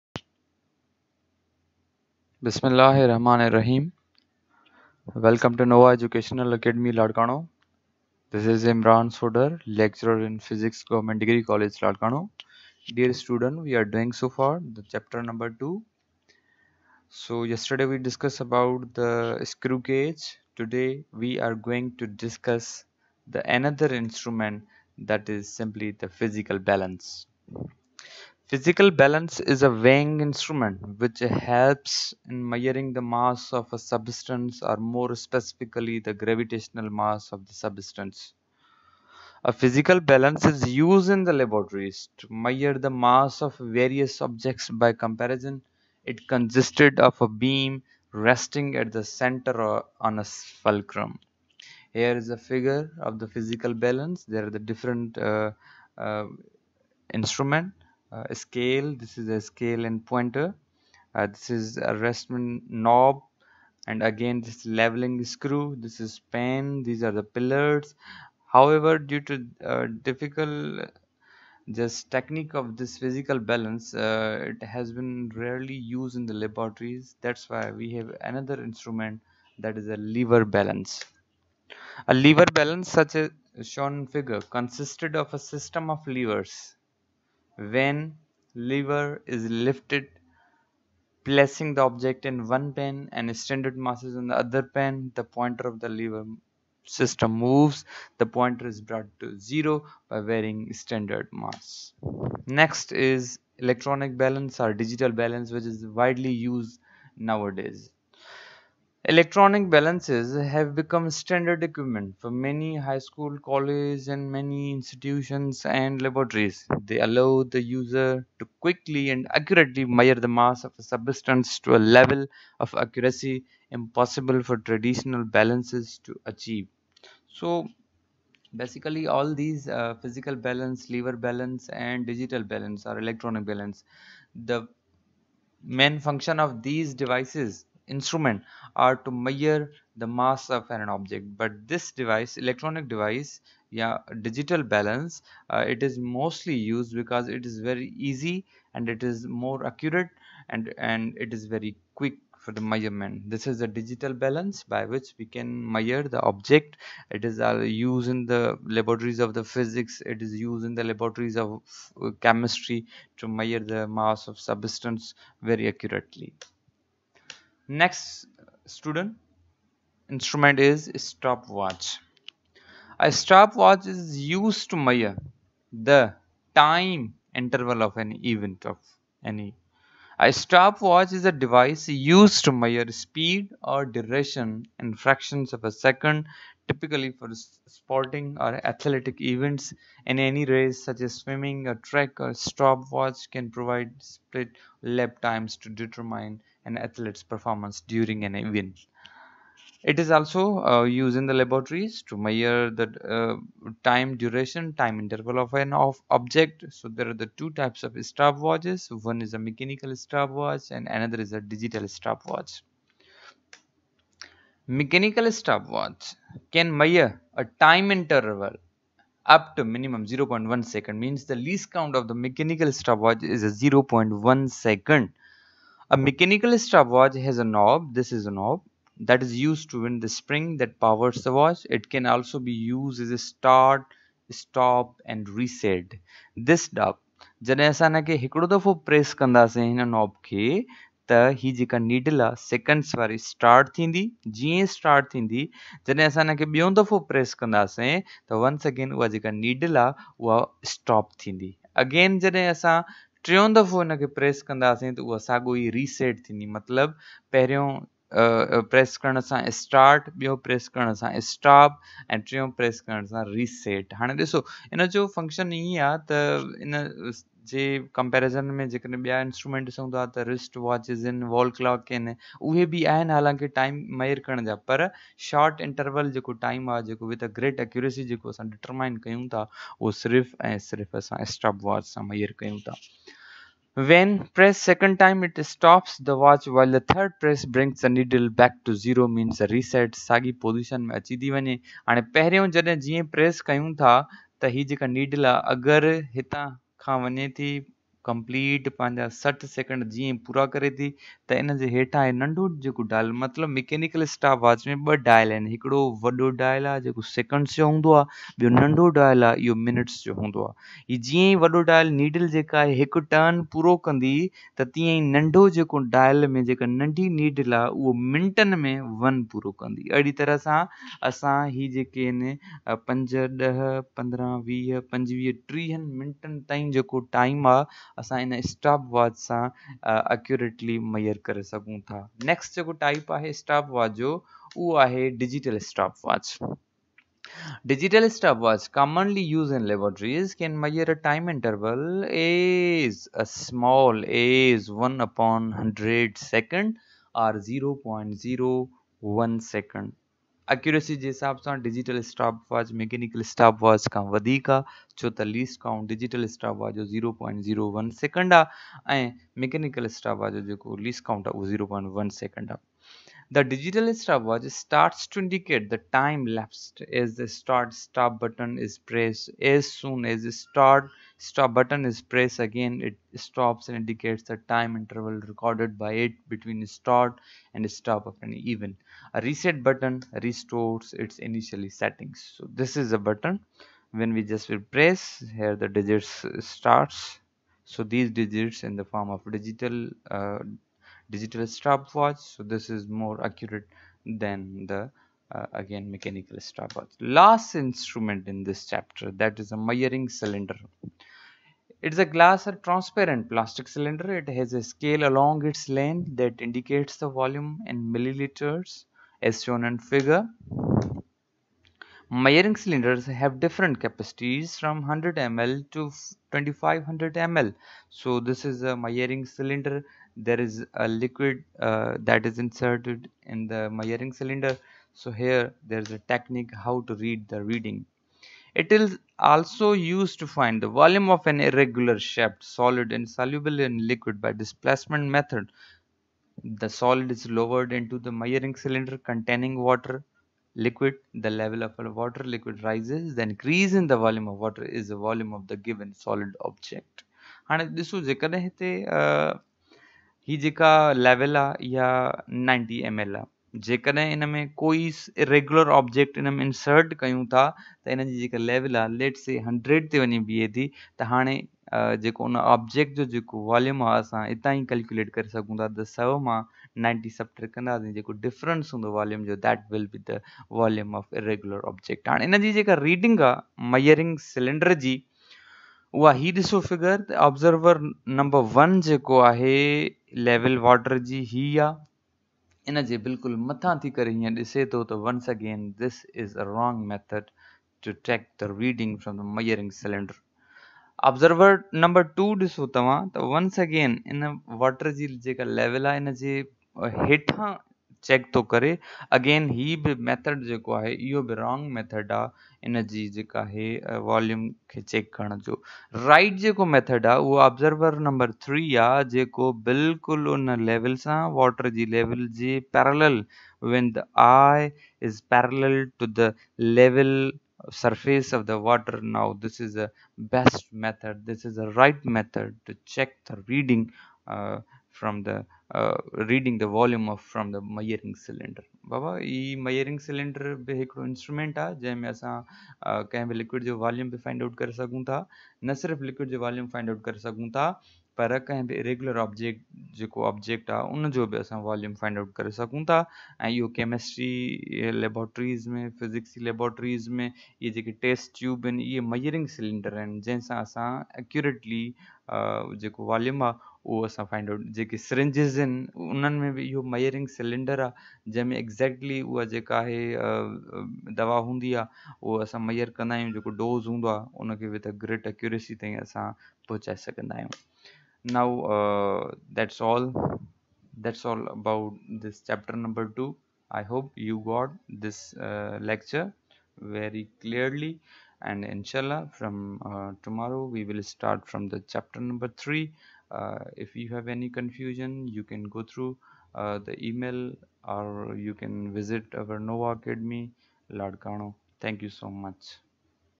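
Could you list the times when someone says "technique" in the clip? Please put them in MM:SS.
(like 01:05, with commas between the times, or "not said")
01:12, 07:05.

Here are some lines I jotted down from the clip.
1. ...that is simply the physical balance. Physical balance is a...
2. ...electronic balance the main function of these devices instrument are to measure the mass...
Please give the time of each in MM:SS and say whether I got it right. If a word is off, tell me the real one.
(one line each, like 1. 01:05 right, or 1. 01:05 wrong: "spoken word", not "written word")
1. 00:24 right
2. 02:12 right.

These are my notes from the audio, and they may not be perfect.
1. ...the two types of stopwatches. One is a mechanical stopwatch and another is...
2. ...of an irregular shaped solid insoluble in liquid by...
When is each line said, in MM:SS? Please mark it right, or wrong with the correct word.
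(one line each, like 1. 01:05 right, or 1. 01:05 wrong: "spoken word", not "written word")
1. 03:27 right
2. 07:11 right.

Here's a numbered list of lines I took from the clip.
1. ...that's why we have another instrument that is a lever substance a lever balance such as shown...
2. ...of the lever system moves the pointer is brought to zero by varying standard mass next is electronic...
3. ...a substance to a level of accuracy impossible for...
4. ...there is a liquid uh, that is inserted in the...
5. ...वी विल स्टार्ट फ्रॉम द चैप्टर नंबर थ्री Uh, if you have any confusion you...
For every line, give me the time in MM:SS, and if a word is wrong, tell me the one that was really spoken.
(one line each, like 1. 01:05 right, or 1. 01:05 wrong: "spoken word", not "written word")
1. 01:17 wrong: "balance", not "substance"
2. 01:35 right
3. 02:00 right
4. 07:00 right
5. 09:40 right.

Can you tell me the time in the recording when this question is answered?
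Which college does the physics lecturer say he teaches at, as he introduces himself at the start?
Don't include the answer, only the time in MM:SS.
00:10.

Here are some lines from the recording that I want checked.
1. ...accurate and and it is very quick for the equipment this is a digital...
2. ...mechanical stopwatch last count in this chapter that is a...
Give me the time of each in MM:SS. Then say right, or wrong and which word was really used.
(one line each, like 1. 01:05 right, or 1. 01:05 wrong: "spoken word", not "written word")
1. 02:29 wrong: "measurement", not "equipment"
2. 06:35 wrong: "instrument", not "count".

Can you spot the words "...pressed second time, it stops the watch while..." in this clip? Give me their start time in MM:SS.
04:44.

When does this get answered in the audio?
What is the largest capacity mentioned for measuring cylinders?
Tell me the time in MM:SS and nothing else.
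06:56.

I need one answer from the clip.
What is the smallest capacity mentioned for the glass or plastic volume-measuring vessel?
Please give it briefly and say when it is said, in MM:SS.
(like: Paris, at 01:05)
100 ml, at 06:54.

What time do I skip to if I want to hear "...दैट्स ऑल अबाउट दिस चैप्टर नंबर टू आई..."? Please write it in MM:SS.
09:31.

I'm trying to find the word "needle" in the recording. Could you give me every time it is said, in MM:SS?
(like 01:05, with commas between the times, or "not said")
04:47.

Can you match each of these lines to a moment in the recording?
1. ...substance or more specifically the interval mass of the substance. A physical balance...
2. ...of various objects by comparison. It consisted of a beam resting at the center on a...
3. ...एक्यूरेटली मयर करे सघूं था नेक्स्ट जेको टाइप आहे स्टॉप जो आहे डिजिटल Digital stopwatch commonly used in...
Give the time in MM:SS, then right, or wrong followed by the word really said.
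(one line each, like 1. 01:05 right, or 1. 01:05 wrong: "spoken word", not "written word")
1. 00:33 wrong: "gravitational", not "interval"
2. 00:43 right
3. 05:30 right.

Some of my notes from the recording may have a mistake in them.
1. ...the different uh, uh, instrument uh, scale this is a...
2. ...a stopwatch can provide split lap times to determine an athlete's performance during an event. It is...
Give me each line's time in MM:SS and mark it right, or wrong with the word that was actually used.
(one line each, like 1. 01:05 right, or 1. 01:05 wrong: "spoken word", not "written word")
1. 00:54 right
2. 03:12 right.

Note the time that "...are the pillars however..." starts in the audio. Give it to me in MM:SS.
01:07.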